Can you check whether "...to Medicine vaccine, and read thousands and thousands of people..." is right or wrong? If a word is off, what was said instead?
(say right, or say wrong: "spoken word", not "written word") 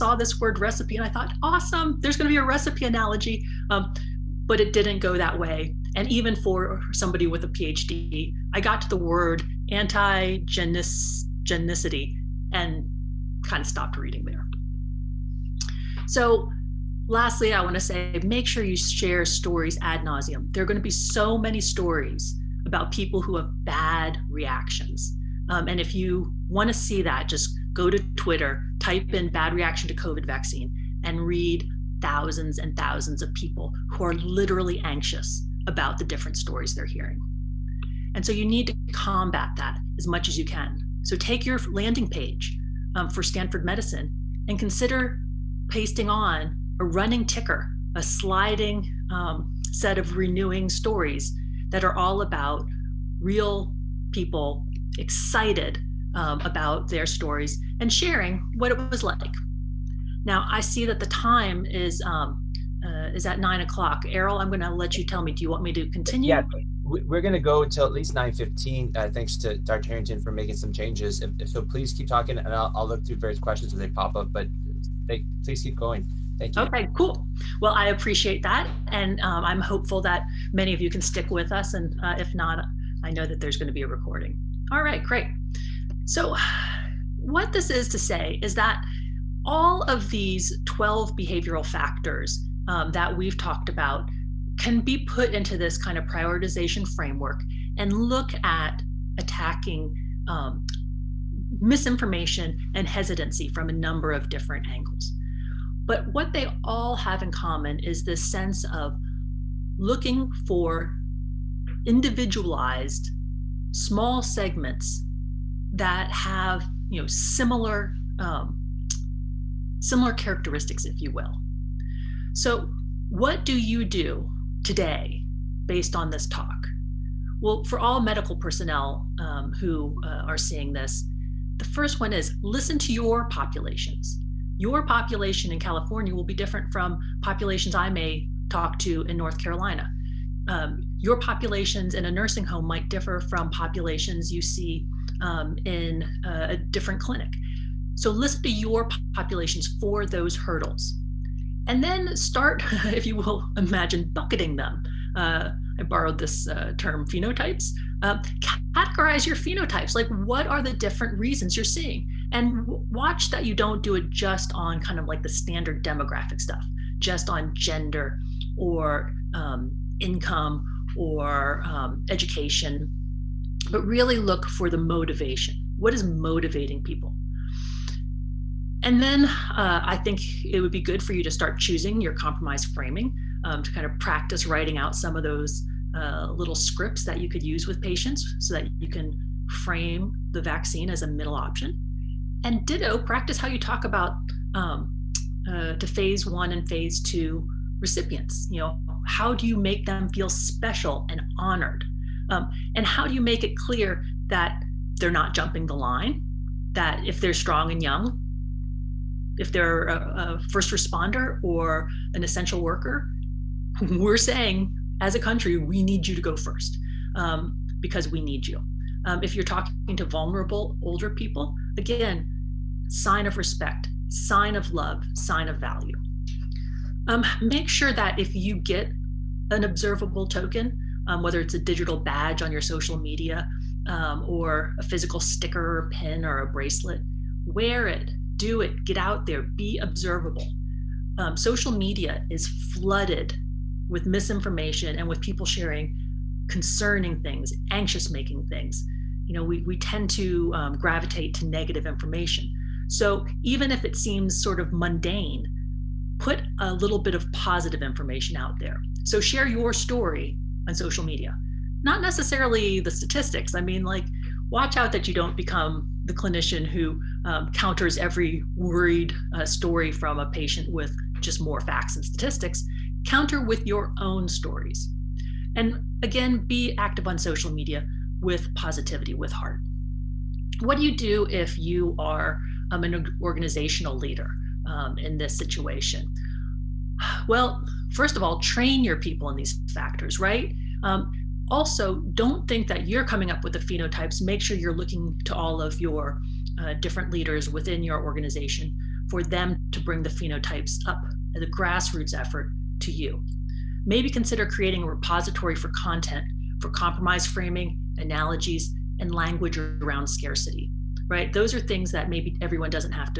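wrong: "COVID", not "Medicine".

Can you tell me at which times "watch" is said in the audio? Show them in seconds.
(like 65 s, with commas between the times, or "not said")
162 s, 264 s.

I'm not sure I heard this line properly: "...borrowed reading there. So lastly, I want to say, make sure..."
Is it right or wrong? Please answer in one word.
wrong.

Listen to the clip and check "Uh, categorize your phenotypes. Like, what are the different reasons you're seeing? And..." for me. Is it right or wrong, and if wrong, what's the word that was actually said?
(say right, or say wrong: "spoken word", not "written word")
right.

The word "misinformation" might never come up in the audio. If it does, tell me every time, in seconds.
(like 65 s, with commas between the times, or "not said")
101 s, 244 s.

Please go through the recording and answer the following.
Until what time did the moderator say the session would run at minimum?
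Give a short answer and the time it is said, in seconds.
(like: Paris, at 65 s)
9:15, at 68 s.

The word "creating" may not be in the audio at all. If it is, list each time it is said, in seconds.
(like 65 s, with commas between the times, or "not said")
304 s.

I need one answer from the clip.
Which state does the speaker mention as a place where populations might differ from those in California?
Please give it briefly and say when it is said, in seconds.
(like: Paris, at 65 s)
North Carolina, at 139 s.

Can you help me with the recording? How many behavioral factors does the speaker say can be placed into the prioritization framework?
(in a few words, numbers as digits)
12.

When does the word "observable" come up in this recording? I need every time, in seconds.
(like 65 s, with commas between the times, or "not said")
229 s, 239 s.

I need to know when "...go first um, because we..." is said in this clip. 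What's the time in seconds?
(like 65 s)
216 s.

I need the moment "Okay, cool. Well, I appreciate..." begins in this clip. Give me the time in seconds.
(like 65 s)
76 s.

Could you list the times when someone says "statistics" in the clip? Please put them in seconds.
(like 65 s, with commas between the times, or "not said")
262 s, 272 s.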